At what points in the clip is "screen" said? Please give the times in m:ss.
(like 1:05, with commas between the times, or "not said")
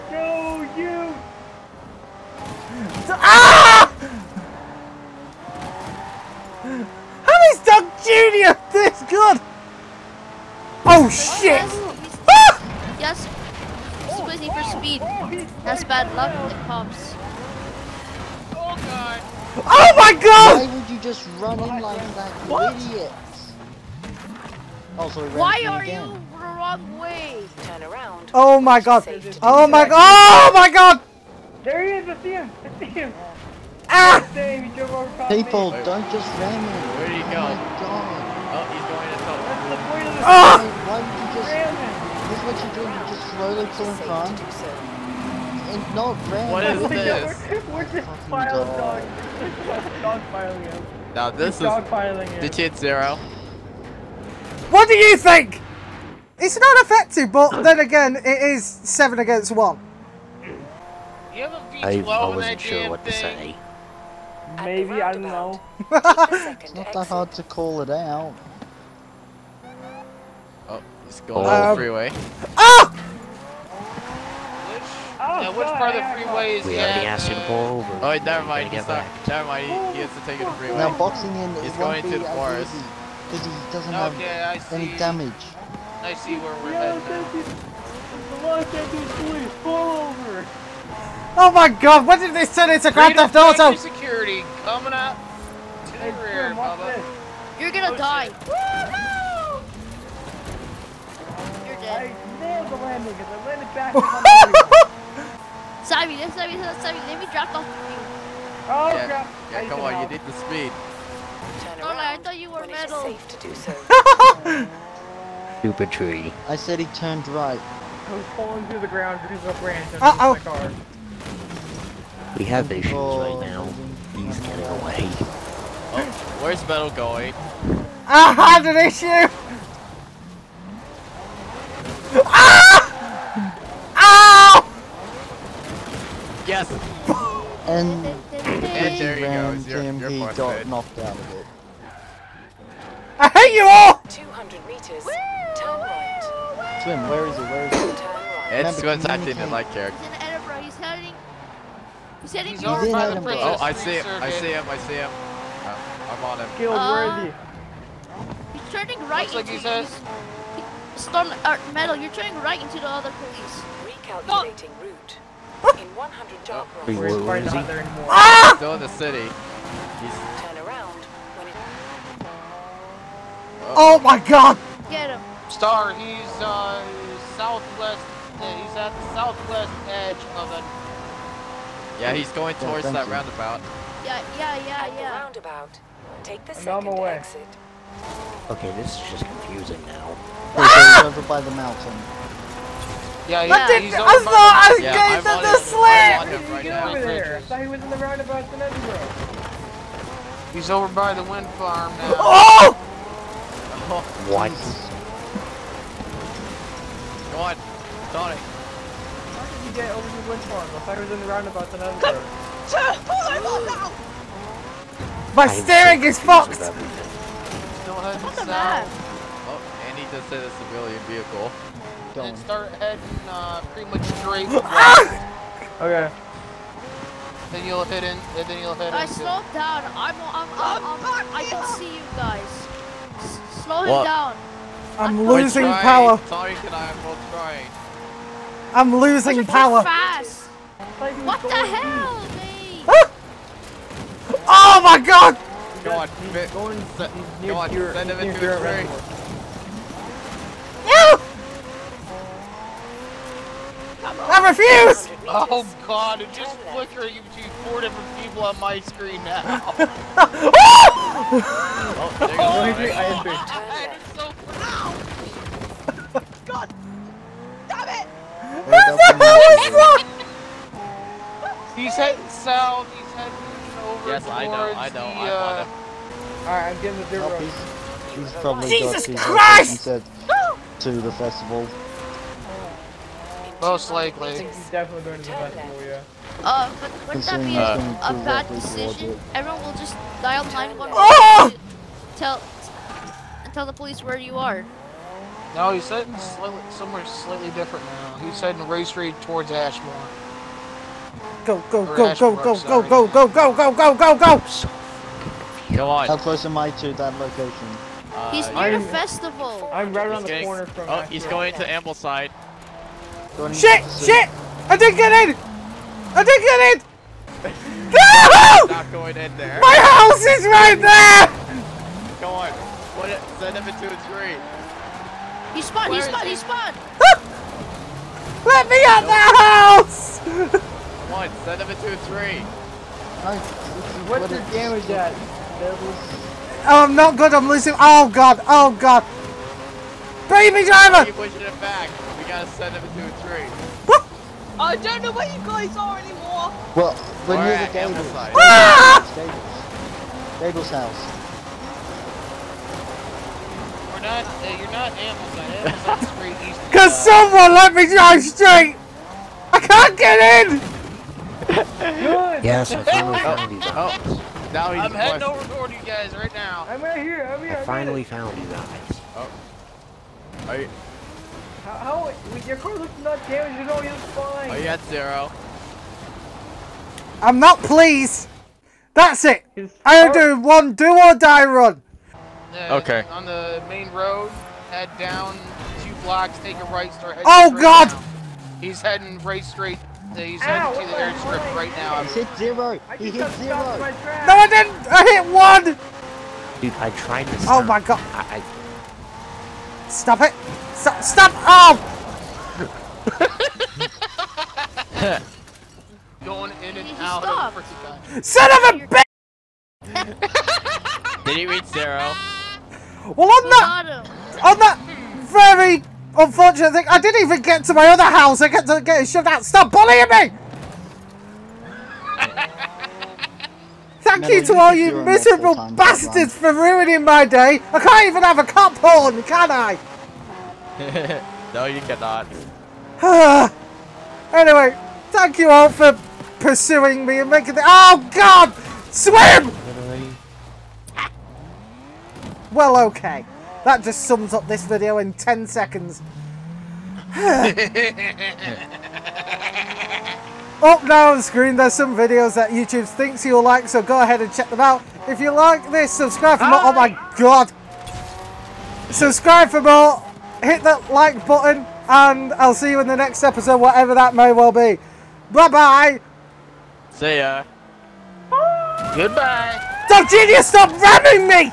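4:18, 7:31.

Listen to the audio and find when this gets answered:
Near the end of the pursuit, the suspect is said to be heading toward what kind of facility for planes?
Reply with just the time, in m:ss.
6:30.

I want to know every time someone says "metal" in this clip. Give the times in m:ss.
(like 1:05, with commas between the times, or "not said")
1:52, 2:06, 2:41.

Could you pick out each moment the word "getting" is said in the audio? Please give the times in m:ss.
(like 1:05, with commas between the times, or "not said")
2:04, 4:36.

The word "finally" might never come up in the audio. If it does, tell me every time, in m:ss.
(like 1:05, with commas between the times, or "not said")
6:02, 6:07.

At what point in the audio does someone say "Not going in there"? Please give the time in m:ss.
5:18.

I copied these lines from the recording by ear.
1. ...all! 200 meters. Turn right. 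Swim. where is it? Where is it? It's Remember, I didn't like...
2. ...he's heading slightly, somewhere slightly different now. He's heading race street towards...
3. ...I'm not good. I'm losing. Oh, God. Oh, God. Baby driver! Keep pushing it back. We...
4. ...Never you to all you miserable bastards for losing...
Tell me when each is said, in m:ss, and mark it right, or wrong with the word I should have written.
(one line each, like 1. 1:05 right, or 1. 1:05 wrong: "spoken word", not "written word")
1. 2:23 right
2. 4:55 right
3. 5:36 right
4. 7:04 wrong: "ruining", not "losing".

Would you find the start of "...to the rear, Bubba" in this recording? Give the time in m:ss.
1:35.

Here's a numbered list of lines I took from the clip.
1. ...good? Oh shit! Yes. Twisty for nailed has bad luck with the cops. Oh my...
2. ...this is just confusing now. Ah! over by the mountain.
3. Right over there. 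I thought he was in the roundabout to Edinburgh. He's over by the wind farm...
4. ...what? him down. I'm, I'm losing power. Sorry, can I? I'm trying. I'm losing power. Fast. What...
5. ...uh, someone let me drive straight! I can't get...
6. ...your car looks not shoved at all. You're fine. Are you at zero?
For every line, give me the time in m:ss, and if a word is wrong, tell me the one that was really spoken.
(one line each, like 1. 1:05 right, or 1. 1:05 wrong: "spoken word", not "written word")
1. 0:09 wrong: "speed", not "nailed"
2. 3:08 right
3. 3:16 right
4. 3:53 right
5. 5:57 right
6. 6:12 wrong: "damaged", not "shoved".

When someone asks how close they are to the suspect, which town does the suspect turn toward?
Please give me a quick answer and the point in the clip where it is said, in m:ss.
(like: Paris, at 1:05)
Ambleside, at 5:11.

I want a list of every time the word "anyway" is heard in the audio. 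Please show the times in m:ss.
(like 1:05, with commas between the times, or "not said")
7:14.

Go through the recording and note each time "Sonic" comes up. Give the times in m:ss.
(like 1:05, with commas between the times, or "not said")
3:28.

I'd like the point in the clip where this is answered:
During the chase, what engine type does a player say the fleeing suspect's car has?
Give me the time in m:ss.
1:02.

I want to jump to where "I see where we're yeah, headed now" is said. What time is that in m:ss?
1:25.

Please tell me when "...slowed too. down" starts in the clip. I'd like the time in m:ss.
3:49.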